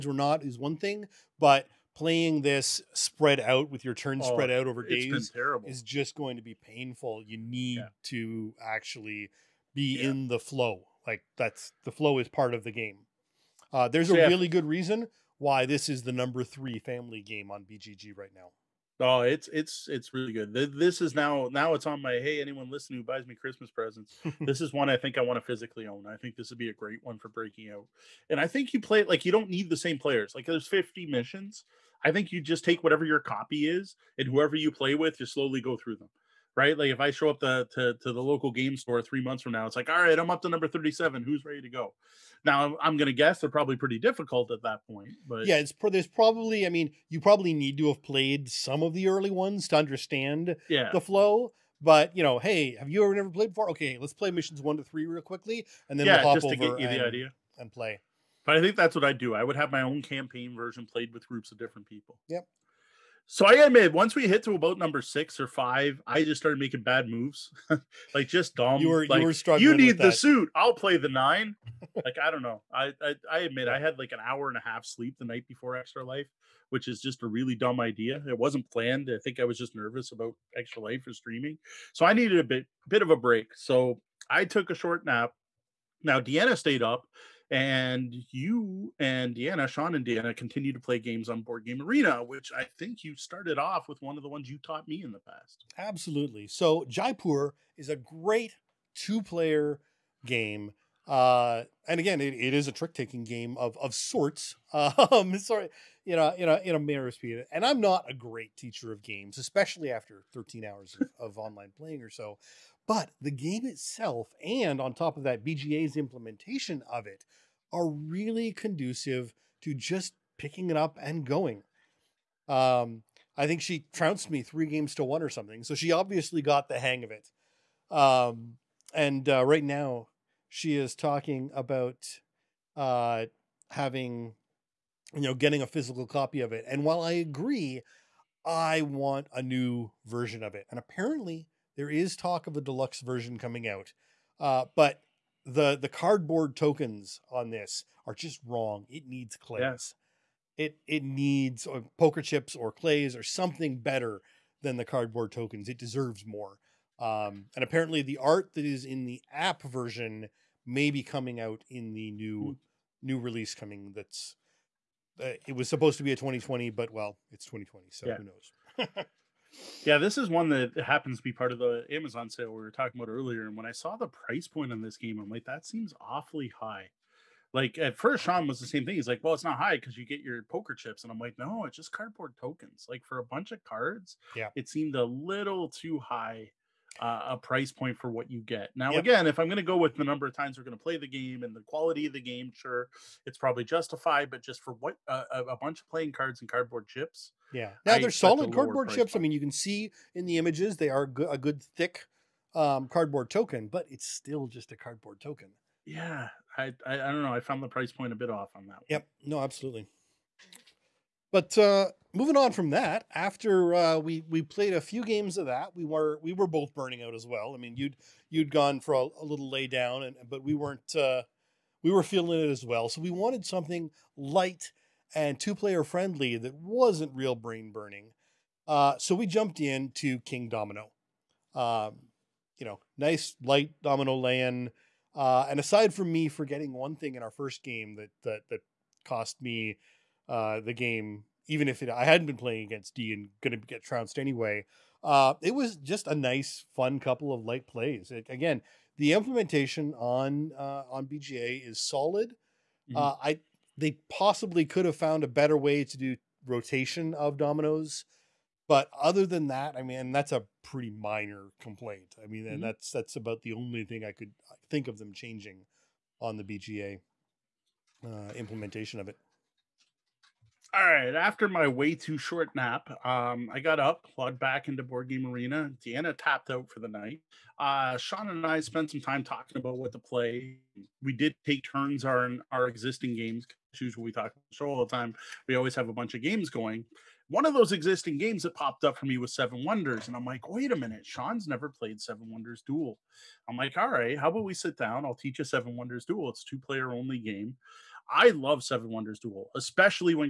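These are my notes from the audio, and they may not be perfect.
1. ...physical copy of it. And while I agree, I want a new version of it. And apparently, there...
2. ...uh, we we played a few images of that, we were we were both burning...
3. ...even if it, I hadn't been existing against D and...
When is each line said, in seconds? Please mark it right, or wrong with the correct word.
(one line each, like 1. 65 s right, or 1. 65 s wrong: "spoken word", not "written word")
1. 135 s right
2. 213 s wrong: "games", not "images"
3. 241 s wrong: "playing", not "existing".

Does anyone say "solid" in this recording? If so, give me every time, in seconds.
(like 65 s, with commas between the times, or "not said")
198 s, 251 s.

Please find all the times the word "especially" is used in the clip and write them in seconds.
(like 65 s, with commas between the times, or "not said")
109 s, 299 s.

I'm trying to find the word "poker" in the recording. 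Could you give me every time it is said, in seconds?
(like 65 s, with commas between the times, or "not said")
151 s, 180 s.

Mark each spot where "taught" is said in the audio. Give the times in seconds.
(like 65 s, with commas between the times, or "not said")
94 s.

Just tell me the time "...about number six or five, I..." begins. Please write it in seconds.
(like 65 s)
64 s.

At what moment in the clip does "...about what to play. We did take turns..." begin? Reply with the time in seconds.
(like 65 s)
279 s.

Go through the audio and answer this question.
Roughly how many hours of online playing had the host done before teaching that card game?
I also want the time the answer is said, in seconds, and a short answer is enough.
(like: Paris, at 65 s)
13, at 110 s.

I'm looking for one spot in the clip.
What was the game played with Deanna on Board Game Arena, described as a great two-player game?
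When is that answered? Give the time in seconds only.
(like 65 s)
96 s.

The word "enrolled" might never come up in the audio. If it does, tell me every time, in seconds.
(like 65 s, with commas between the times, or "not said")
not said.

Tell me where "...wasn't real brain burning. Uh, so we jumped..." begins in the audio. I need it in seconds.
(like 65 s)
226 s.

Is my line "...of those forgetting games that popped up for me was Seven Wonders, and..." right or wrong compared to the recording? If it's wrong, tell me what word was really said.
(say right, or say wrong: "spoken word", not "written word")
wrong: "existing", not "forgetting".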